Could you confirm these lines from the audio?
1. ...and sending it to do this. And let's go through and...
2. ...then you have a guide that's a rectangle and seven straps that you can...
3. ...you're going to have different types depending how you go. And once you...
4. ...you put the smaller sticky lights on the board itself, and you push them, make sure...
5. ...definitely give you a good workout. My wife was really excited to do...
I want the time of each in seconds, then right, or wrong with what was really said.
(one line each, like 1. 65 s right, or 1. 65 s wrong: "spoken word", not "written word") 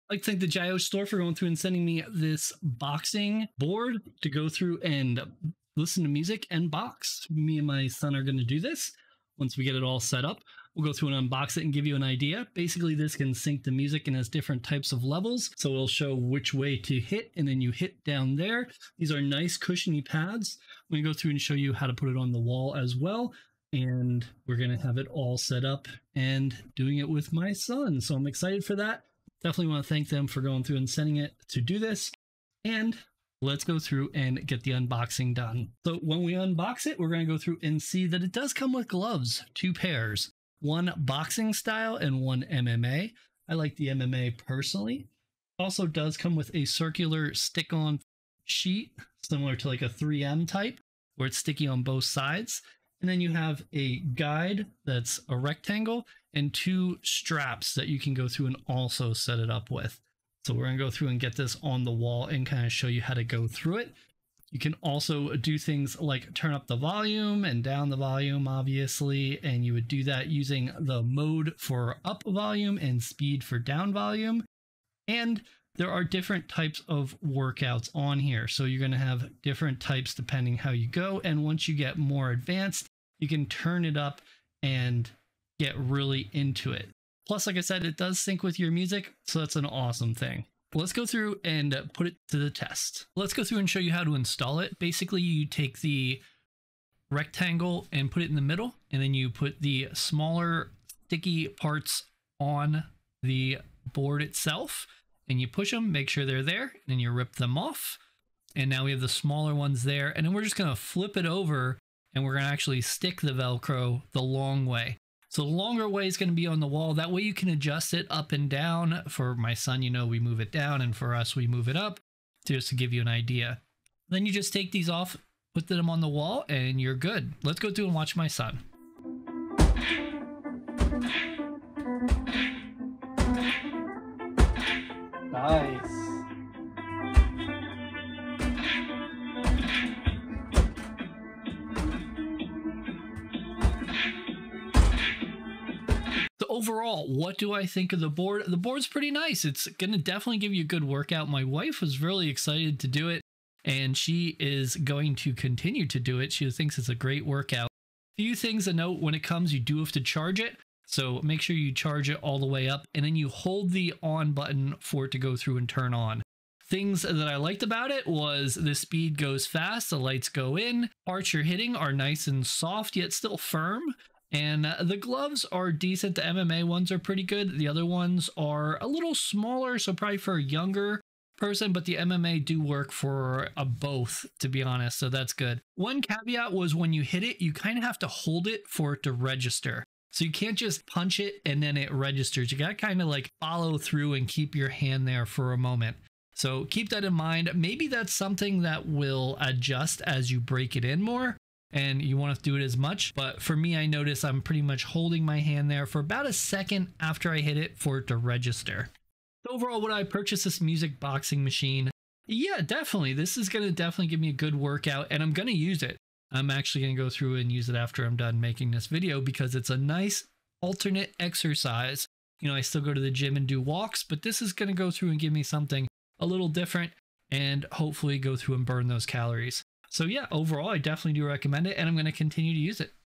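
1. 30 s right
2. 53 s wrong: "two", not "seven"
3. 78 s right
4. 99 s wrong: "parts", not "lights"
5. 149 s right.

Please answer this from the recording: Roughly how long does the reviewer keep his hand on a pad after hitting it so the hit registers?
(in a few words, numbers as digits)
About a second.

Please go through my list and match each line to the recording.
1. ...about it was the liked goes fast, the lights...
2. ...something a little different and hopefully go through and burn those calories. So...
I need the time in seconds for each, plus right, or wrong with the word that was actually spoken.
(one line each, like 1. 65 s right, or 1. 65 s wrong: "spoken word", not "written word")
1. 167 s wrong: "speed", not "liked"
2. 225 s right.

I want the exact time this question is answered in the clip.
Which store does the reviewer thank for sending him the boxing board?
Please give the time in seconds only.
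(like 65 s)
0 s.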